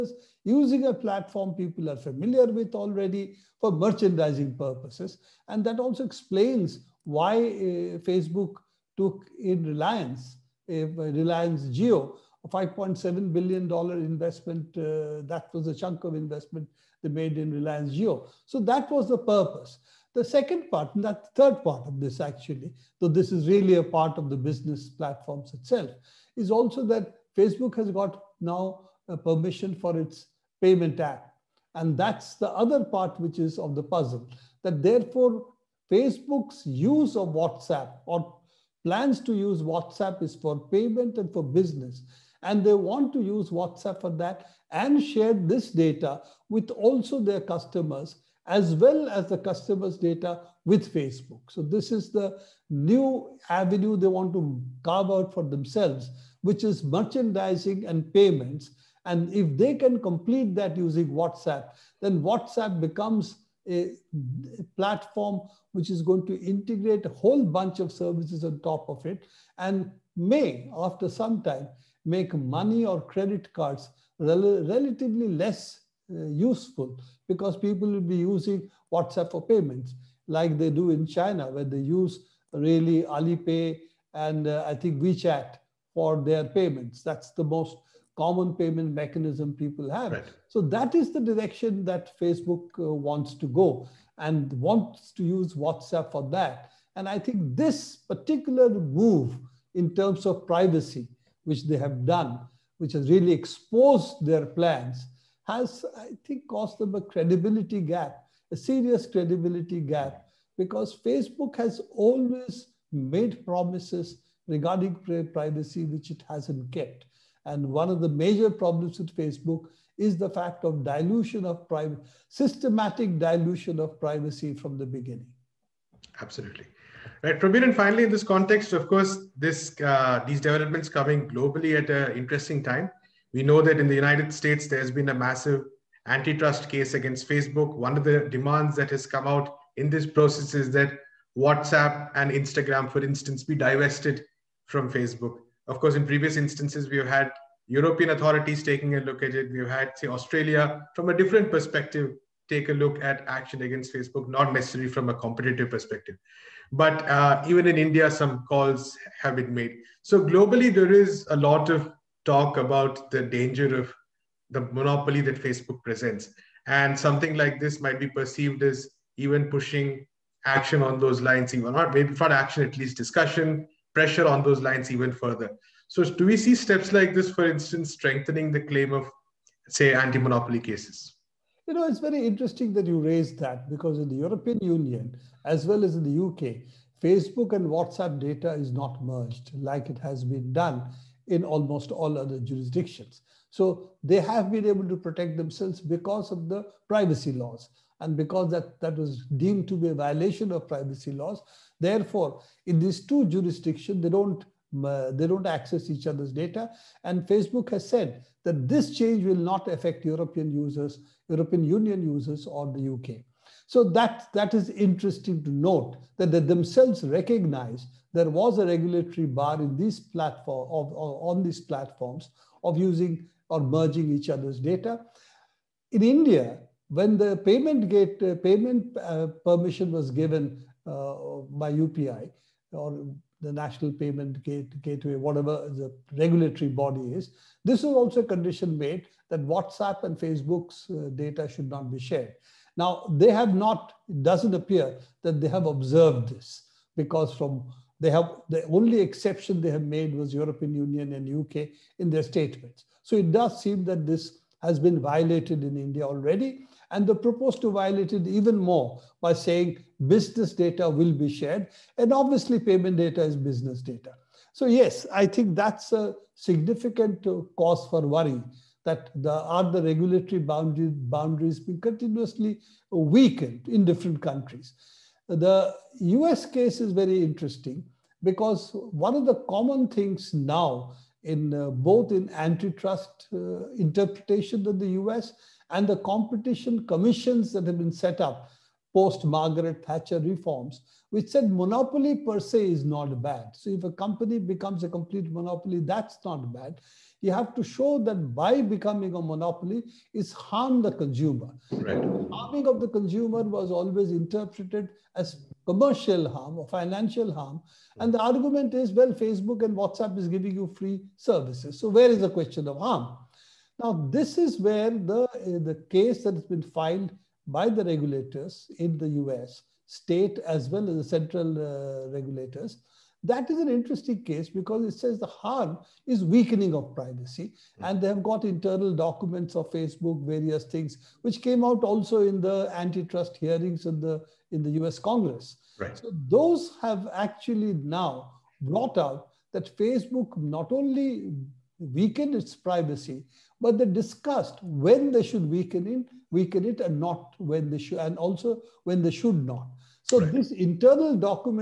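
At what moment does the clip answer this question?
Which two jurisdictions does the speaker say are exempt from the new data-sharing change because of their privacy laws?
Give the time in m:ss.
4:10.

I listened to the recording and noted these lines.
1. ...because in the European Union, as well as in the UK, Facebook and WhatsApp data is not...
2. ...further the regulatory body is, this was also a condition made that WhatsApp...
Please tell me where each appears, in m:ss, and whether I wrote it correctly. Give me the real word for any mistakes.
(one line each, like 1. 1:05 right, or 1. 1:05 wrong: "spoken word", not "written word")
1. 3:03 right
2. 3:55 wrong: "whatever", not "further".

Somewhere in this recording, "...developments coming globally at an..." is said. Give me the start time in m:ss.
2:10.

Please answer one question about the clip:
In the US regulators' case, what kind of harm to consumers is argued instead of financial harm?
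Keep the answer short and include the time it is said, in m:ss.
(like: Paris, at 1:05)
Weakening of privacy, at 5:26.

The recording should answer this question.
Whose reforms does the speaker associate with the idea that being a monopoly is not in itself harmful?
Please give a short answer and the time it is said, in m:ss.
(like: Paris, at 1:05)
Margaret Thatcher, at 4:49.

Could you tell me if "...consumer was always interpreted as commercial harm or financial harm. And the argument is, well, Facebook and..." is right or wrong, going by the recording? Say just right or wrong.
right.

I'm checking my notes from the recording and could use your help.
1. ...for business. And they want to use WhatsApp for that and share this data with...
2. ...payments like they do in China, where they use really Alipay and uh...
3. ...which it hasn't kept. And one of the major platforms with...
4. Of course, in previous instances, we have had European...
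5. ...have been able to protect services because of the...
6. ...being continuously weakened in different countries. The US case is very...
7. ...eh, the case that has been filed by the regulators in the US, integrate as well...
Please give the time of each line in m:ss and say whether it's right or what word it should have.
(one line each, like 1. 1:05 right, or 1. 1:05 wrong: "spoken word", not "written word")
1. 0:41 right
2. 1:19 right
3. 1:55 wrong: "problems", not "platforms"
4. 2:25 right
5. 3:14 wrong: "themselves", not "services"
6. 4:31 right
7. 5:15 wrong: "state", not "integrate".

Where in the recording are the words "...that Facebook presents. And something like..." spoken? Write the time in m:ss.
2:45.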